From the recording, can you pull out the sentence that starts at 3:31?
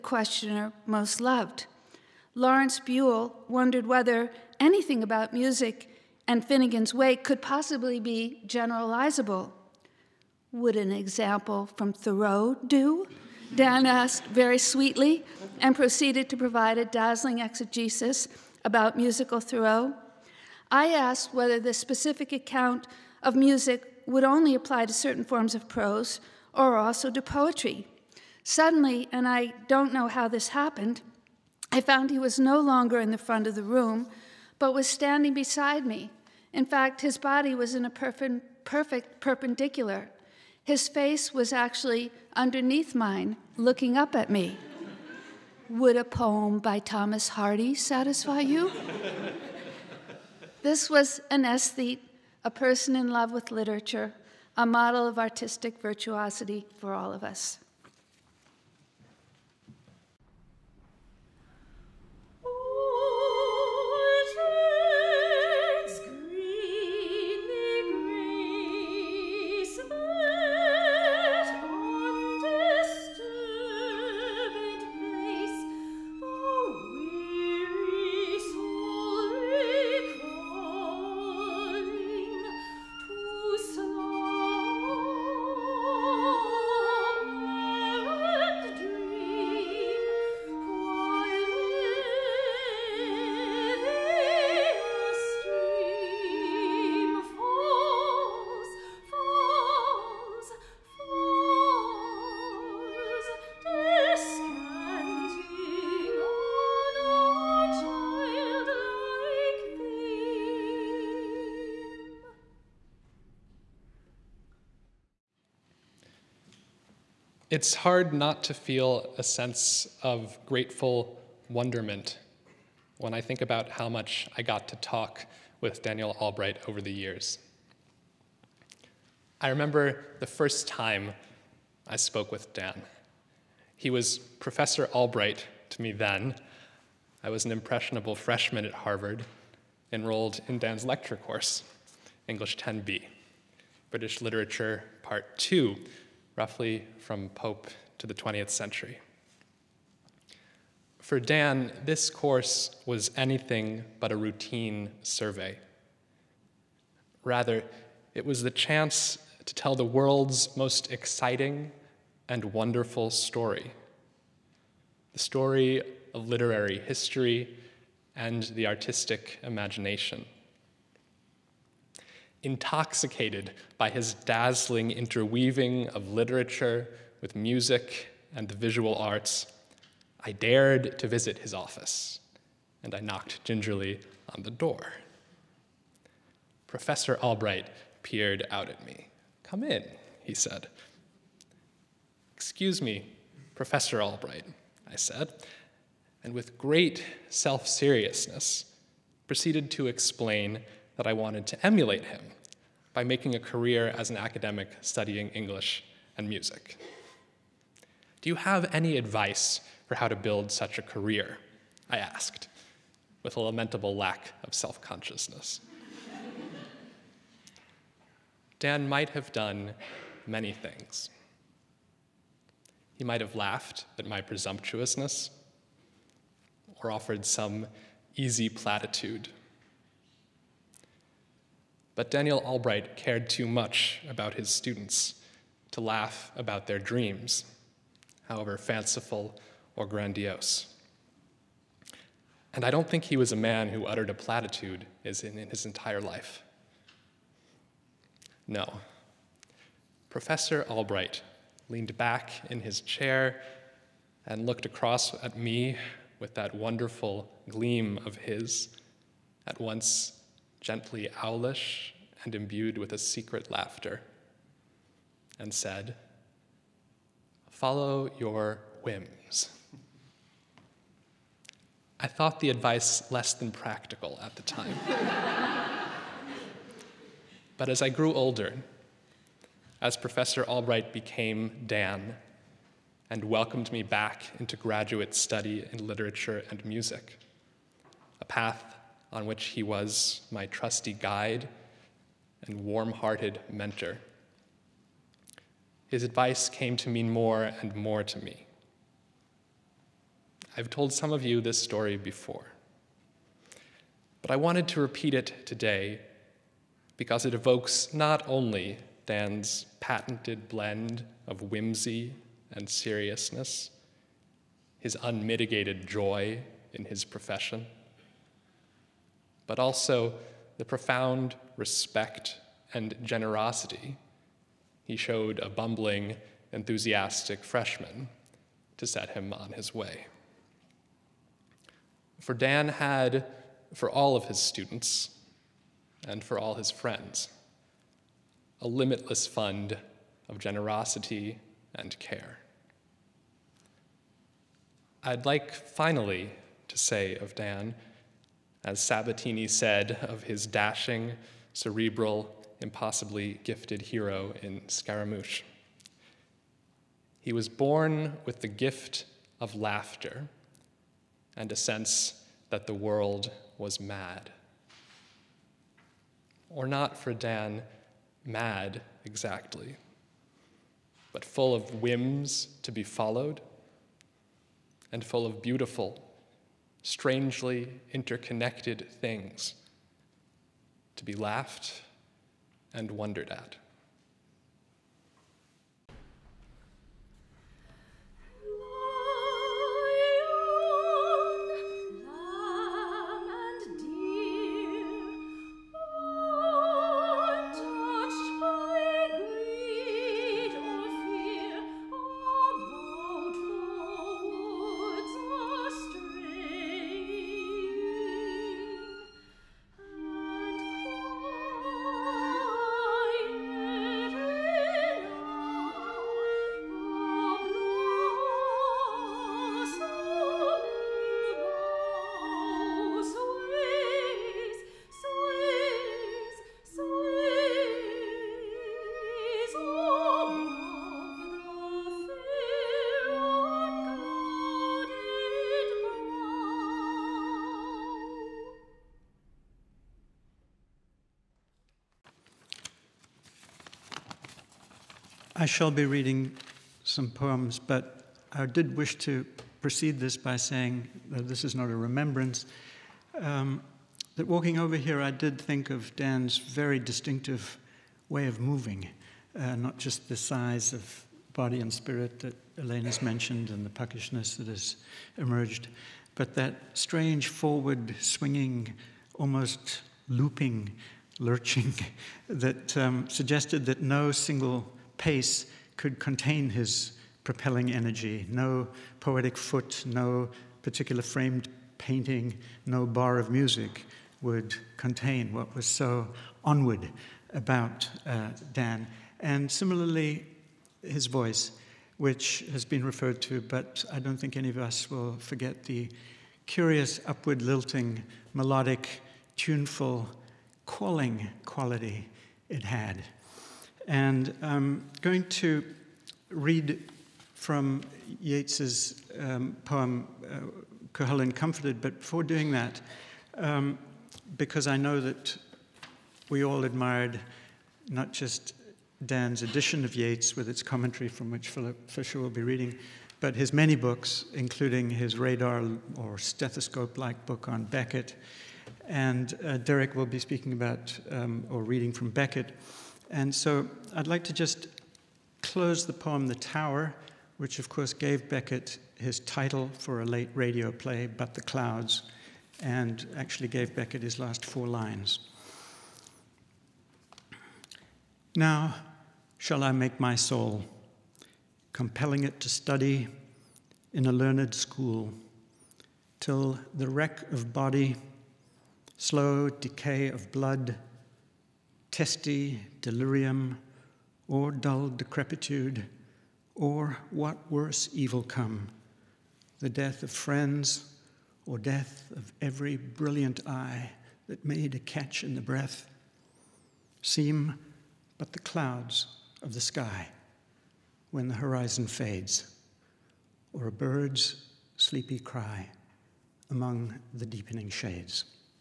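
I asked, with a lamentable lack of self consciousness.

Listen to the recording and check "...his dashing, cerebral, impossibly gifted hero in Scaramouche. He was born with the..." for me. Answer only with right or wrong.
right.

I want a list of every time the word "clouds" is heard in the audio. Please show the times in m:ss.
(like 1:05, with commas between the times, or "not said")
9:01, 9:38.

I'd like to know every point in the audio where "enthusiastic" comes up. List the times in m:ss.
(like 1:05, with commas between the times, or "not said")
5:26.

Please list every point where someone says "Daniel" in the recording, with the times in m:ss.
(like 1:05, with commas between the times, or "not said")
2:05, 3:52.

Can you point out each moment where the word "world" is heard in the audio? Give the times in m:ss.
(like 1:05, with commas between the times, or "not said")
2:39, 6:02.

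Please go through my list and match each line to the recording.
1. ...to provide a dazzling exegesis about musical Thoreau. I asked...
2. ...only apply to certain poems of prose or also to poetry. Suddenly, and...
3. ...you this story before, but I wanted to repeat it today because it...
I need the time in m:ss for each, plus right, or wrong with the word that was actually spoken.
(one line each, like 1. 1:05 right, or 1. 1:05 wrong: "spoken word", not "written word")
1. 0:16 right
2. 0:24 wrong: "forms", not "poems"
3. 5:01 right.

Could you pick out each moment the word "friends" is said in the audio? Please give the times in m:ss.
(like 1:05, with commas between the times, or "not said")
5:36, 9:30.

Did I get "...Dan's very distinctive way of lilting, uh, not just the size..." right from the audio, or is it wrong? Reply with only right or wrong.
wrong.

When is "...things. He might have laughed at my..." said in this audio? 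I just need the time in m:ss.
3:40.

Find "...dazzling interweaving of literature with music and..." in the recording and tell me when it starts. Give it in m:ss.
2:54.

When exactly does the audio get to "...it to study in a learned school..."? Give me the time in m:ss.
9:12.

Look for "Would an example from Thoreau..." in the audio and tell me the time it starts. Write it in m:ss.
0:10.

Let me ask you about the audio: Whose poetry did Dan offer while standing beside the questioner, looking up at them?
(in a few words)
Thomas Hardy.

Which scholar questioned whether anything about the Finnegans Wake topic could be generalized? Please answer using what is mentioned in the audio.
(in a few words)
Lawrence Buell.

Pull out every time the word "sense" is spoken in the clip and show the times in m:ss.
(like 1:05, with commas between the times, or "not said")
1:59, 6:01.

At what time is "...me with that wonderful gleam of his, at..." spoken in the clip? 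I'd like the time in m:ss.
4:15.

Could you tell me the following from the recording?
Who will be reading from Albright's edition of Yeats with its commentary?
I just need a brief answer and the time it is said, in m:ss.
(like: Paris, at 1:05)
Philip Fisher, at 8:41.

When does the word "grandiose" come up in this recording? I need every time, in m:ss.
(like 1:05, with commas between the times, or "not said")
3:59.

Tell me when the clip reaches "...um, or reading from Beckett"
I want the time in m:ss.
8:51.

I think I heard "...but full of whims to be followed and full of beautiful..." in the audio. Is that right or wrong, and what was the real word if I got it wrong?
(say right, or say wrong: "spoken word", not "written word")
right.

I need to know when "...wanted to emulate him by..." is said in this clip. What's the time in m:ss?
3:21.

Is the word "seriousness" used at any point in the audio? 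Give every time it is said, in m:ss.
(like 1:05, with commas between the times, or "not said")
3:17, 5:12.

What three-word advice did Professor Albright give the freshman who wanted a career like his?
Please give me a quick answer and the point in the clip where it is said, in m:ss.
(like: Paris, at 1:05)
Follow your whims, at 4:27.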